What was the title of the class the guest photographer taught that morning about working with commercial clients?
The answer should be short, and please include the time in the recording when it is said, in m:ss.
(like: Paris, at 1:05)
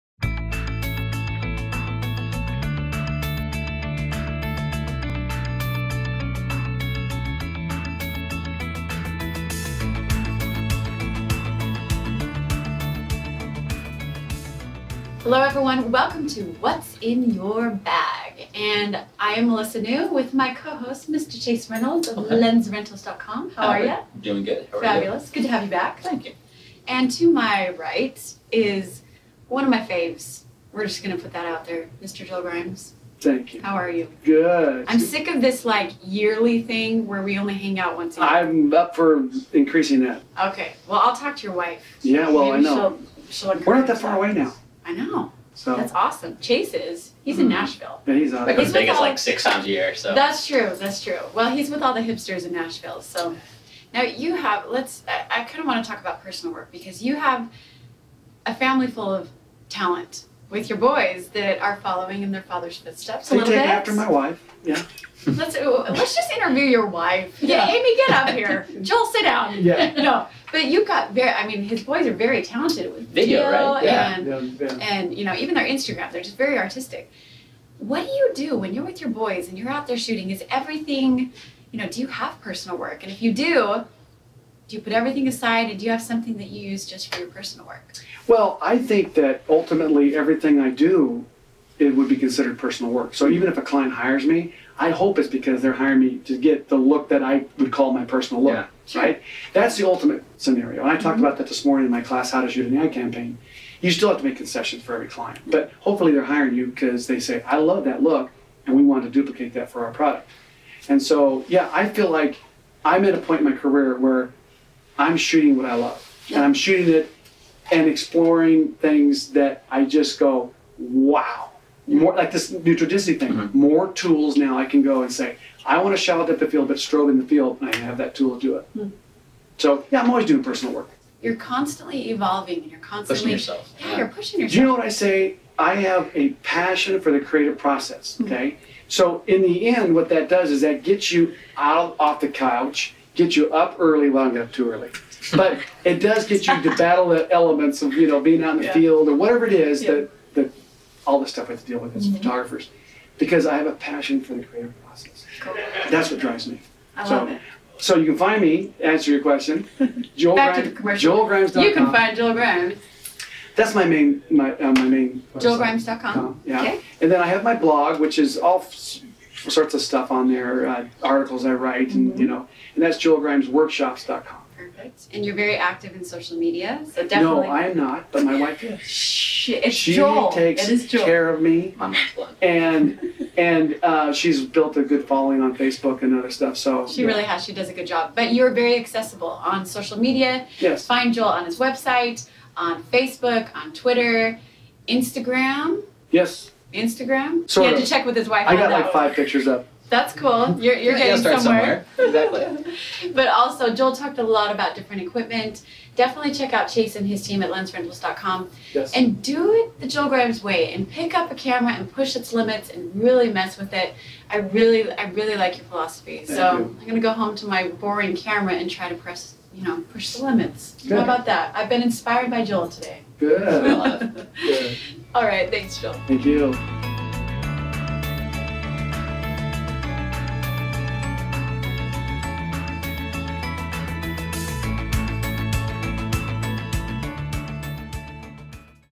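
How to Shoot an Ad Campaign, at 1:42.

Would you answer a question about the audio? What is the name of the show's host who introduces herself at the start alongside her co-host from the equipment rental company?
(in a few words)
Melissa Niu.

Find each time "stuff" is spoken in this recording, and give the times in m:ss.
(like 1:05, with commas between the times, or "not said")
2:31, 2:49, 3:06.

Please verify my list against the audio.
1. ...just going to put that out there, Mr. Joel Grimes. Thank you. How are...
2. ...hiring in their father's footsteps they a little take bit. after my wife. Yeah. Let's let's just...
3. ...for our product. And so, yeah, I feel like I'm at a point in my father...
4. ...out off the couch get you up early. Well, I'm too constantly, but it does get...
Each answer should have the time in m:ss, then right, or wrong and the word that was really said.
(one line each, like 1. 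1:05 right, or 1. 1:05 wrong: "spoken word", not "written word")
1. 0:30 right
2. 1:01 wrong: "following", not "hiring"
3. 1:49 wrong: "career", not "father"
4. 2:21 wrong: "early", not "constantly".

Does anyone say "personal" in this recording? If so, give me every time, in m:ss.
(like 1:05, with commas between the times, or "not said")
0:56, 1:22, 1:27, 1:32, 1:38, 2:10.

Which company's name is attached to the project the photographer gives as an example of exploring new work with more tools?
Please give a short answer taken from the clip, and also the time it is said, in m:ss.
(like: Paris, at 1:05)
Disney, at 2:02.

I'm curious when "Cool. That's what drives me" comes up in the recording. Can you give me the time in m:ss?
2:35.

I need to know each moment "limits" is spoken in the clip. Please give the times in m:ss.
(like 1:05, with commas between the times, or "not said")
3:32, 3:40.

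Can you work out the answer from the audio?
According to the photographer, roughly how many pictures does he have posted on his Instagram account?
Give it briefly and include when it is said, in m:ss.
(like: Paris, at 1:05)
5, at 3:18.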